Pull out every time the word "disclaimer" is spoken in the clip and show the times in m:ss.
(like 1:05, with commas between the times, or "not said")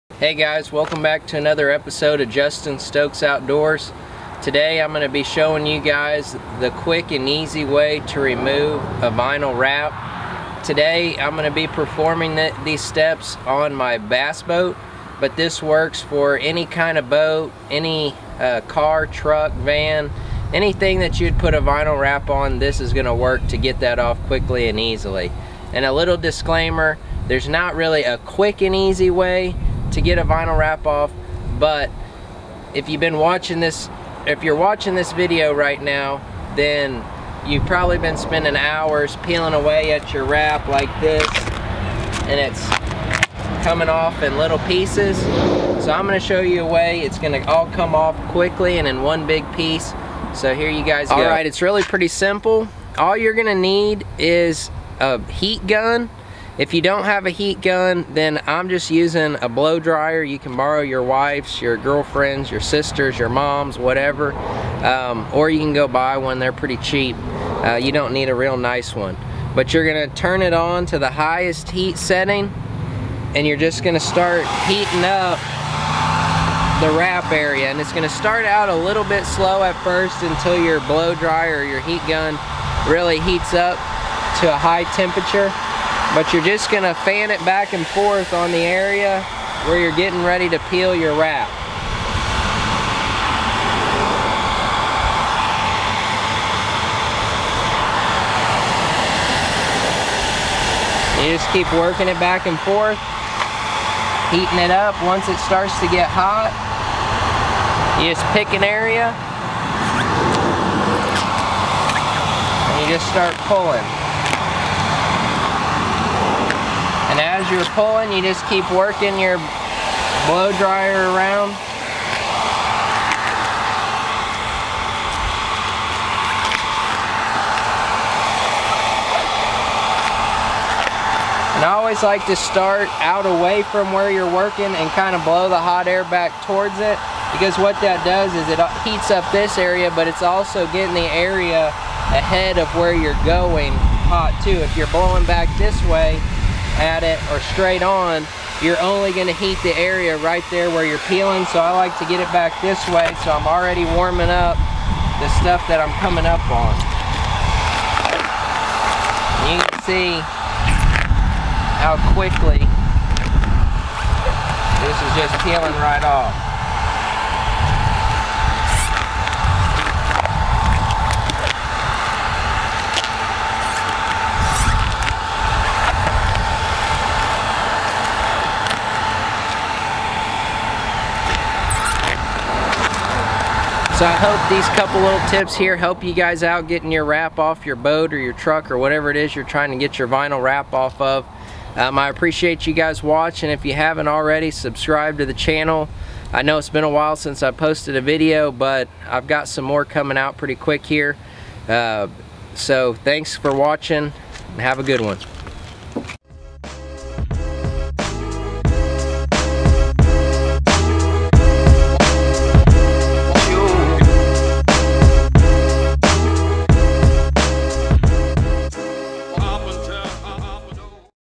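0:26.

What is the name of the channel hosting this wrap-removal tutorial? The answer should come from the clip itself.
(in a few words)
Justin Stokes Outdoors.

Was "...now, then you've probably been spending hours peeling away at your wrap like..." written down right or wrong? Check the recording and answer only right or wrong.
right.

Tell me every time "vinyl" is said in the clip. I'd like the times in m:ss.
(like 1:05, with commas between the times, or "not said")
0:09, 0:21, 0:30, 3:10.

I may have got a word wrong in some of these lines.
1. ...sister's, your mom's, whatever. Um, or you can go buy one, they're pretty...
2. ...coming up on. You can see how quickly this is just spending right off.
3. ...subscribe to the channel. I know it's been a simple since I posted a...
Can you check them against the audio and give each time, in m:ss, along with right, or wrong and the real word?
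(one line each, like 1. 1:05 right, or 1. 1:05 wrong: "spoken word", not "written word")
1. 1:02 right
2. 2:36 wrong: "peeling", not "spending"
3. 3:14 wrong: "while", not "simple".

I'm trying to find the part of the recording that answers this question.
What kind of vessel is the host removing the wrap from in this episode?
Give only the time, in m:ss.
0:13.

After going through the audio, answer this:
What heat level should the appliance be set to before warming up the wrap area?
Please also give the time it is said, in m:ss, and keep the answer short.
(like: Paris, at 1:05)
Highest heat setting, at 1:11.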